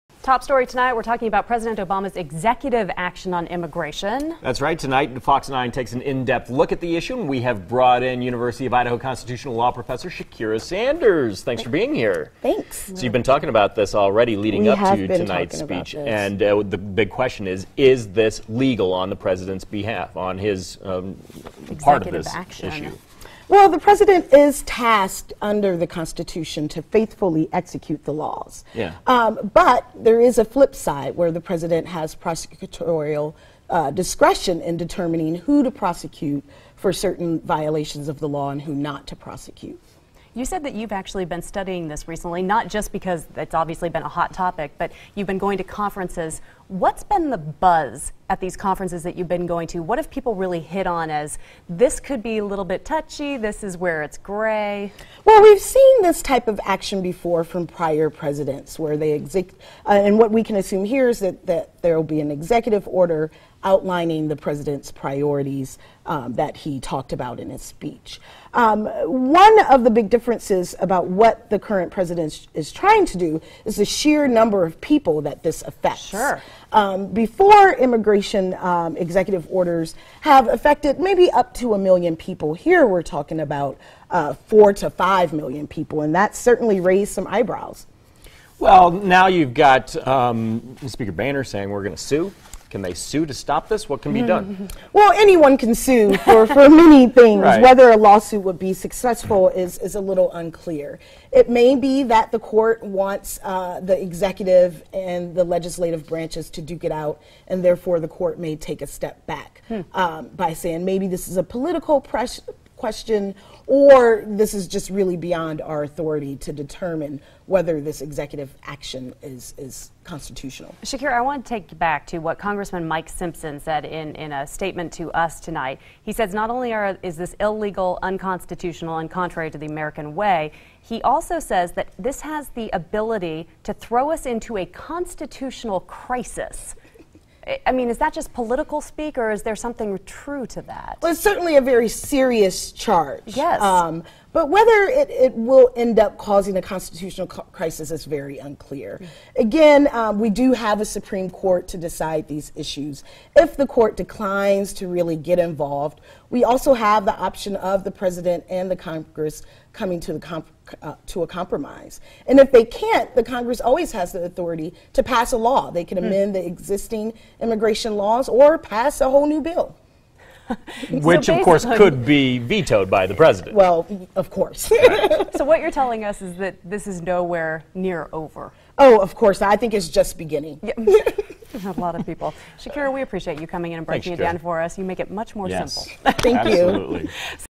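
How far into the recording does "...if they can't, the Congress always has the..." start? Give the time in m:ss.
2:42.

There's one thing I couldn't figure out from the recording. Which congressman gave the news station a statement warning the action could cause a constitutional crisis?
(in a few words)
Mike Simpson.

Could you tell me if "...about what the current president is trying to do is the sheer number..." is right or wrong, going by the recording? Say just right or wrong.
right.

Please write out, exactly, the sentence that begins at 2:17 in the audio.
I mean, is that just political speak, or is there something true to that?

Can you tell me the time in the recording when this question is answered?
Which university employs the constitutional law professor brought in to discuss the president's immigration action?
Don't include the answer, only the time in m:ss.
0:08.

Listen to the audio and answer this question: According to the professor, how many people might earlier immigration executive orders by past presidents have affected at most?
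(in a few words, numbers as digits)
1 million.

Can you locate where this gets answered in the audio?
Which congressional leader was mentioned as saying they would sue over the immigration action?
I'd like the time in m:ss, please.
1:30.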